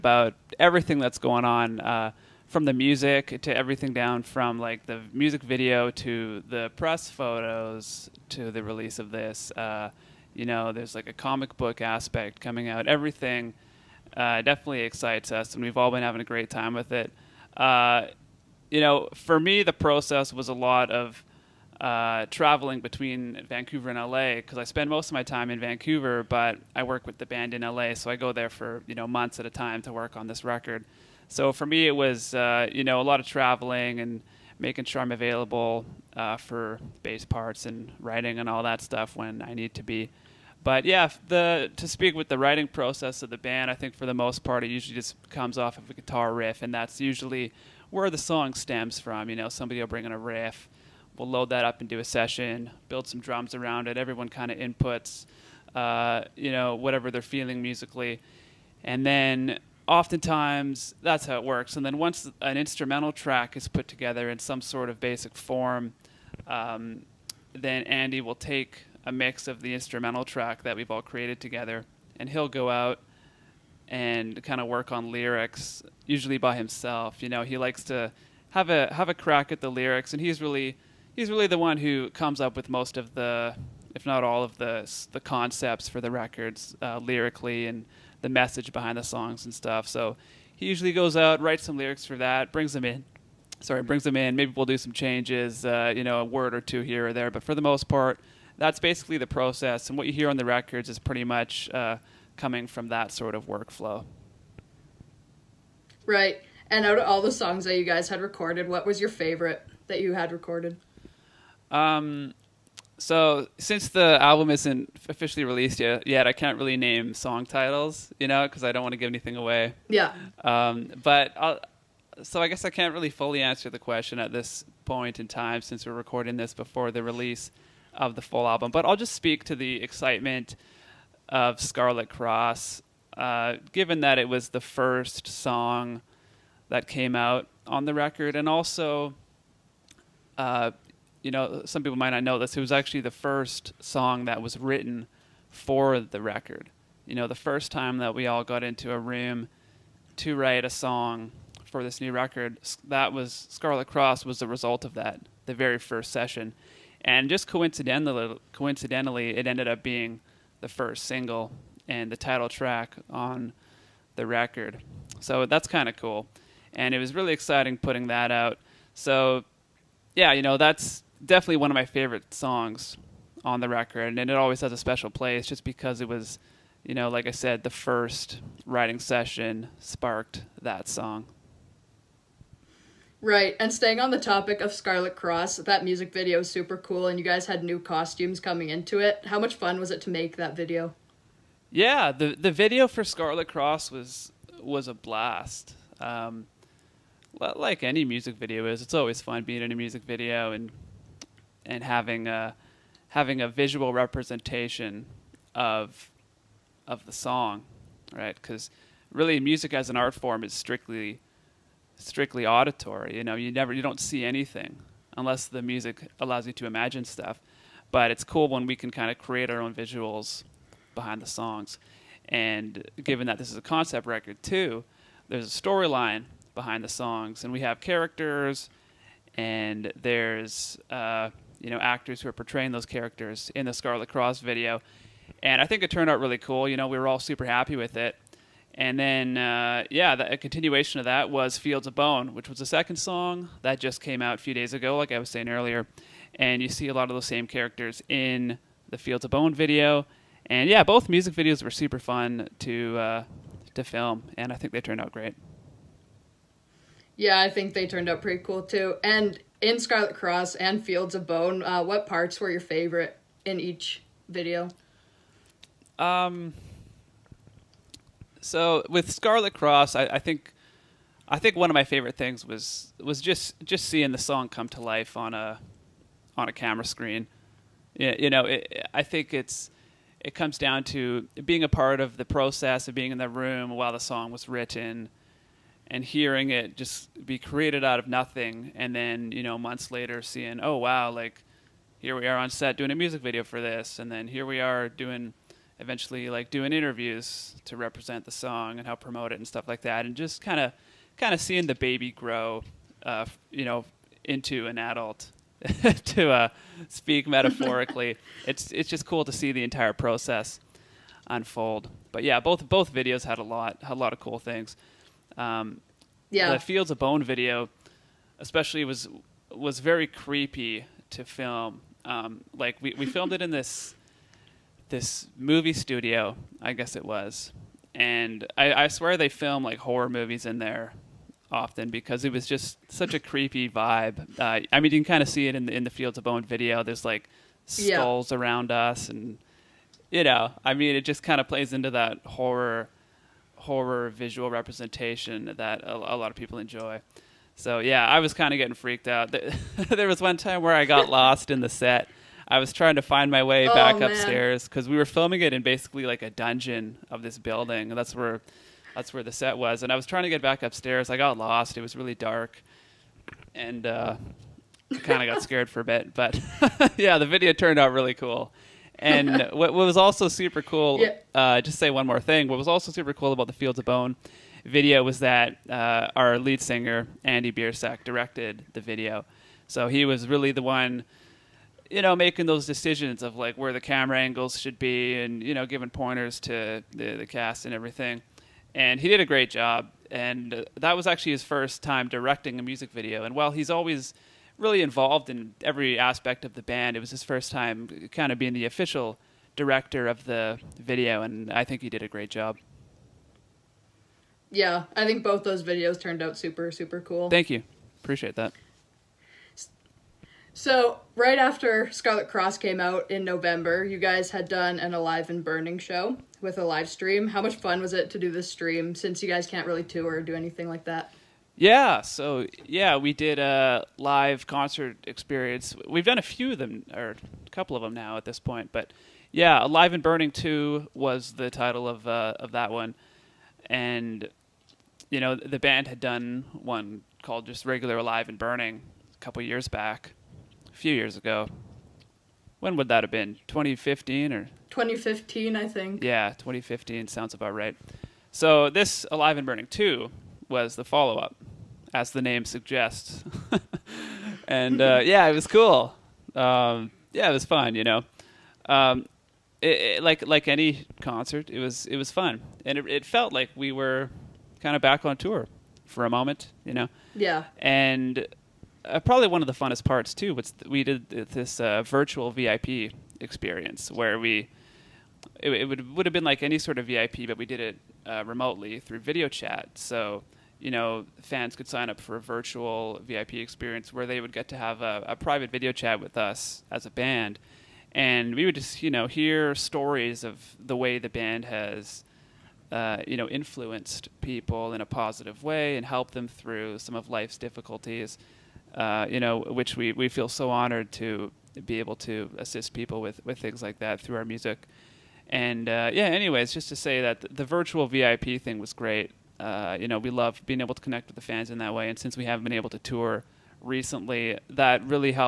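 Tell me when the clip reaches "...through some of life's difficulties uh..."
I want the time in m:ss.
8:16.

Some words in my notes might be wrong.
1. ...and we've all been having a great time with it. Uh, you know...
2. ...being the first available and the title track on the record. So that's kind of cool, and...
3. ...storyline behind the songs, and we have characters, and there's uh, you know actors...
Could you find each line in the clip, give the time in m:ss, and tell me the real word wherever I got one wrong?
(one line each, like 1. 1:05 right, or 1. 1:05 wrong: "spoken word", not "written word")
1. 0:15 right
2. 2:39 wrong: "single", not "available"
3. 3:45 right.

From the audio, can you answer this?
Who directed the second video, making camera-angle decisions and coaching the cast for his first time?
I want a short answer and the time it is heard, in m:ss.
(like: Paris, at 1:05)
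Andy Biersack, at 6:17.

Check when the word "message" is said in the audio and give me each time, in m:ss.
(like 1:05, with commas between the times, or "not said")
1:28.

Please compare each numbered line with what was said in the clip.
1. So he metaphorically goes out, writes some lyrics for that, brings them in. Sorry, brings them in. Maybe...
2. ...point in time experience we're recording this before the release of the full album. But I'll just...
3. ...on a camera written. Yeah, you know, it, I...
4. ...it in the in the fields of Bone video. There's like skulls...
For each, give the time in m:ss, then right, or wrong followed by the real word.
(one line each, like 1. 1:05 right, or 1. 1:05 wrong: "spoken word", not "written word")
1. 1:29 wrong: "usually", not "metaphorically"
2. 2:04 wrong: "since", not "experience"
3. 4:36 wrong: "screen", not "written"
4. 5:35 right.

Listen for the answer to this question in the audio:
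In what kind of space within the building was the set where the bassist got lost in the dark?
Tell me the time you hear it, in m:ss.
5:56.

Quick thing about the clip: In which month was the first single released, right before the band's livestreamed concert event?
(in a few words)
November.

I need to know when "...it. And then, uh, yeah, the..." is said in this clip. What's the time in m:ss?
3:57.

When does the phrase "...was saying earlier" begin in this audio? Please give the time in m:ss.
4:05.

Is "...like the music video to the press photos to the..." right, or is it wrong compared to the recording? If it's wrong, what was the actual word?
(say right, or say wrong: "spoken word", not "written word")
right.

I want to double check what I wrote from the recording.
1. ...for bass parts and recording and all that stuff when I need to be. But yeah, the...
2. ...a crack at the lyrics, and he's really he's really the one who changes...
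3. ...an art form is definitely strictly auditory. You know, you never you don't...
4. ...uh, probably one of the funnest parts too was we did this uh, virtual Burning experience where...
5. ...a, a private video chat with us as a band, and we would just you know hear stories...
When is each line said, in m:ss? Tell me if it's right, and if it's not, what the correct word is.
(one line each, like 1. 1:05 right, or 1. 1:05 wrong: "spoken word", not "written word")
1. 0:36 wrong: "writing", not "recording"
2. 1:19 wrong: "comes", not "changes"
3. 3:29 wrong: "strictly", not "definitely"
4. 7:48 wrong: "VIP", not "Burning"
5. 8:04 right.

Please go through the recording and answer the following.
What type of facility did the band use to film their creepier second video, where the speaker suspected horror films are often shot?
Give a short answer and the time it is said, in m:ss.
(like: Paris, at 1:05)
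movie studio, at 5:25.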